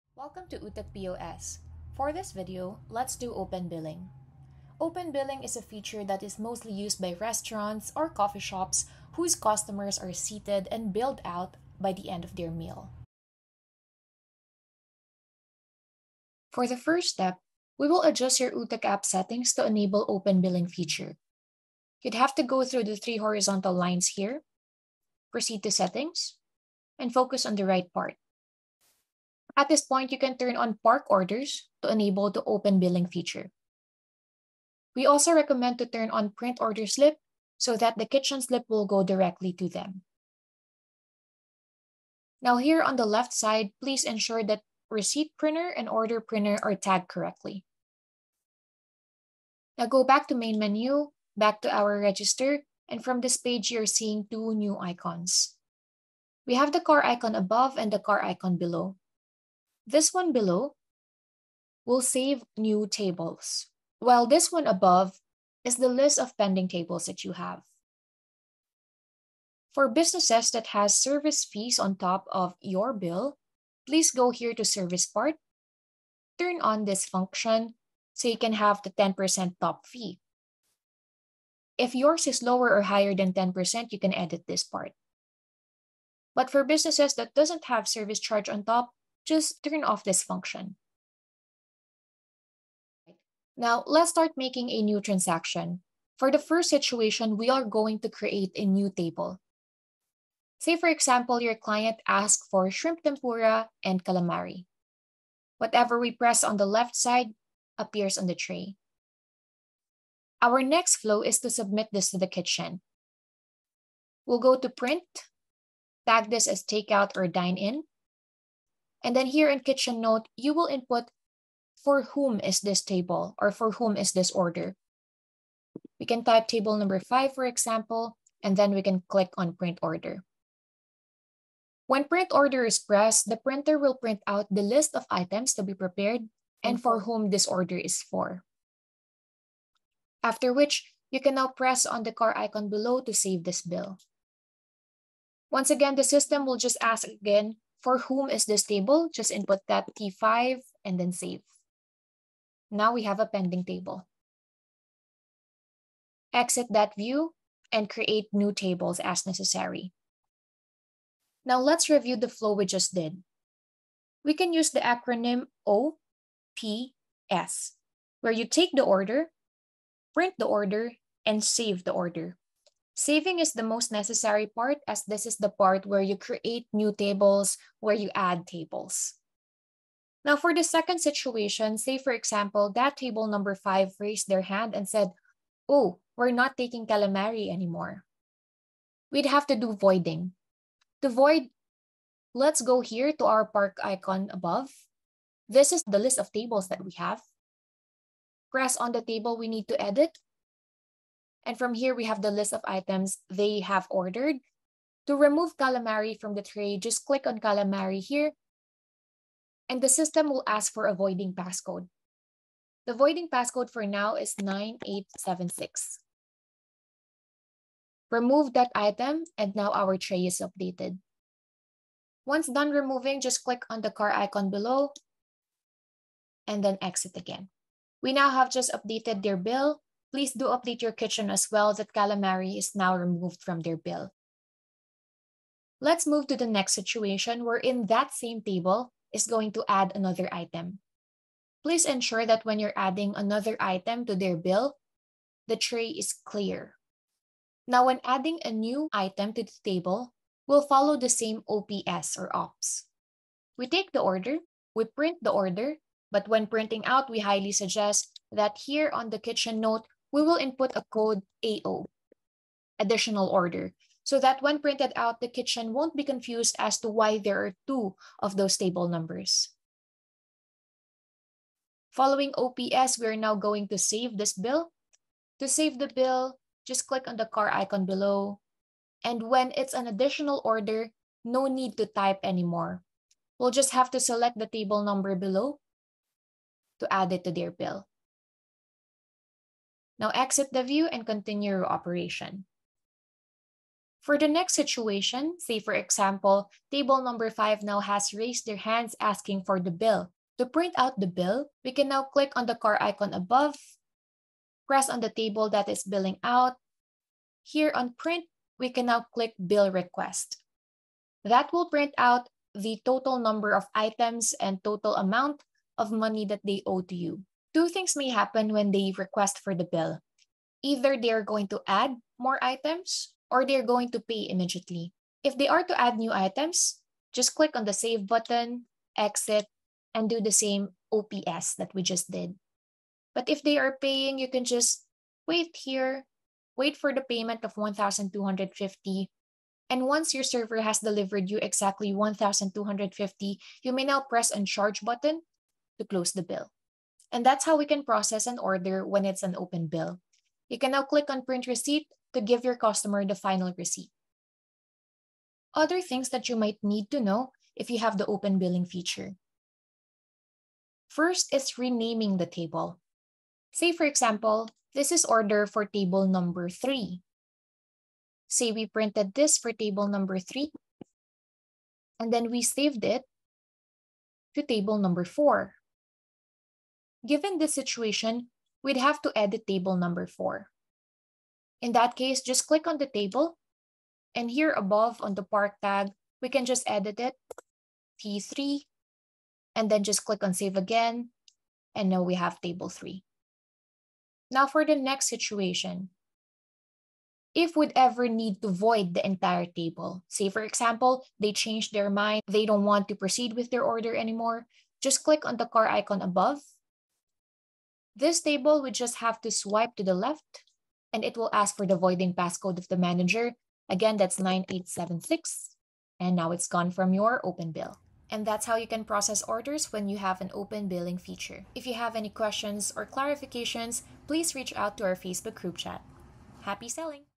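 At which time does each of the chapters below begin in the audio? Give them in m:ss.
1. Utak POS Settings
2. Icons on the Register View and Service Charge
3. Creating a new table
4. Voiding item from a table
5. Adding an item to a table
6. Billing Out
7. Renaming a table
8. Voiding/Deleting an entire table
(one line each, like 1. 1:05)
1. 0:20
2. 0:50
3. 1:40
4. 3:00
5. 4:00
6. 4:53
7. 5:55
8. 6:36.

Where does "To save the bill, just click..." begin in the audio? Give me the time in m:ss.
4:35.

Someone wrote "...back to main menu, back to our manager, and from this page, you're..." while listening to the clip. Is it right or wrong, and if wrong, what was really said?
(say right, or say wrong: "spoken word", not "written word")
wrong: "register", not "manager".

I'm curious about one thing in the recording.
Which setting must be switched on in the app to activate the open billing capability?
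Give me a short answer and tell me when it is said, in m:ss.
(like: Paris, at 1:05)
Park orders, at 0:30.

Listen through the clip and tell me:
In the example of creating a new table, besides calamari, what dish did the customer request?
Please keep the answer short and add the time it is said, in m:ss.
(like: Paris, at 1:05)
Shrimp tempura, at 1:42.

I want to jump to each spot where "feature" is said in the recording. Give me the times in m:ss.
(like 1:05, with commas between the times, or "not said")
0:05, 0:20, 0:33, 5:58, 7:00.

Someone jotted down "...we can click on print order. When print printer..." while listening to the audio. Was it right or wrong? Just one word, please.
wrong.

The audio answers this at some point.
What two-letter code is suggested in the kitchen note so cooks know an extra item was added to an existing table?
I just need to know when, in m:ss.
4:21.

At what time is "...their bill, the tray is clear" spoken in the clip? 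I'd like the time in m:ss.
4:04.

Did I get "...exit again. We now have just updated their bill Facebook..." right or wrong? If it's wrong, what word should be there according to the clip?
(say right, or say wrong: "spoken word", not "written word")
wrong: "Please", not "Facebook".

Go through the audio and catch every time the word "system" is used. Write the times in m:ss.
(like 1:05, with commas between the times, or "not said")
2:26, 3:29.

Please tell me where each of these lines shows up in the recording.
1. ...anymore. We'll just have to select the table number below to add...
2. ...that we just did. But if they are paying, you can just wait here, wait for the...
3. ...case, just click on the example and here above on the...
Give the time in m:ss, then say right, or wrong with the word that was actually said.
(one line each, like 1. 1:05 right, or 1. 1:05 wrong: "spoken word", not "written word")
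1. 4:42 right
2. 5:31 right
3. 6:21 wrong: "table", not "example".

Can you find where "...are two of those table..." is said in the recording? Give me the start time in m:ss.
4:27.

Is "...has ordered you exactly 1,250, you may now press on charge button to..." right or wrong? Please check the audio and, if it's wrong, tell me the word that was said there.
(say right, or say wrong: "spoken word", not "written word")
wrong: "delivered", not "ordered".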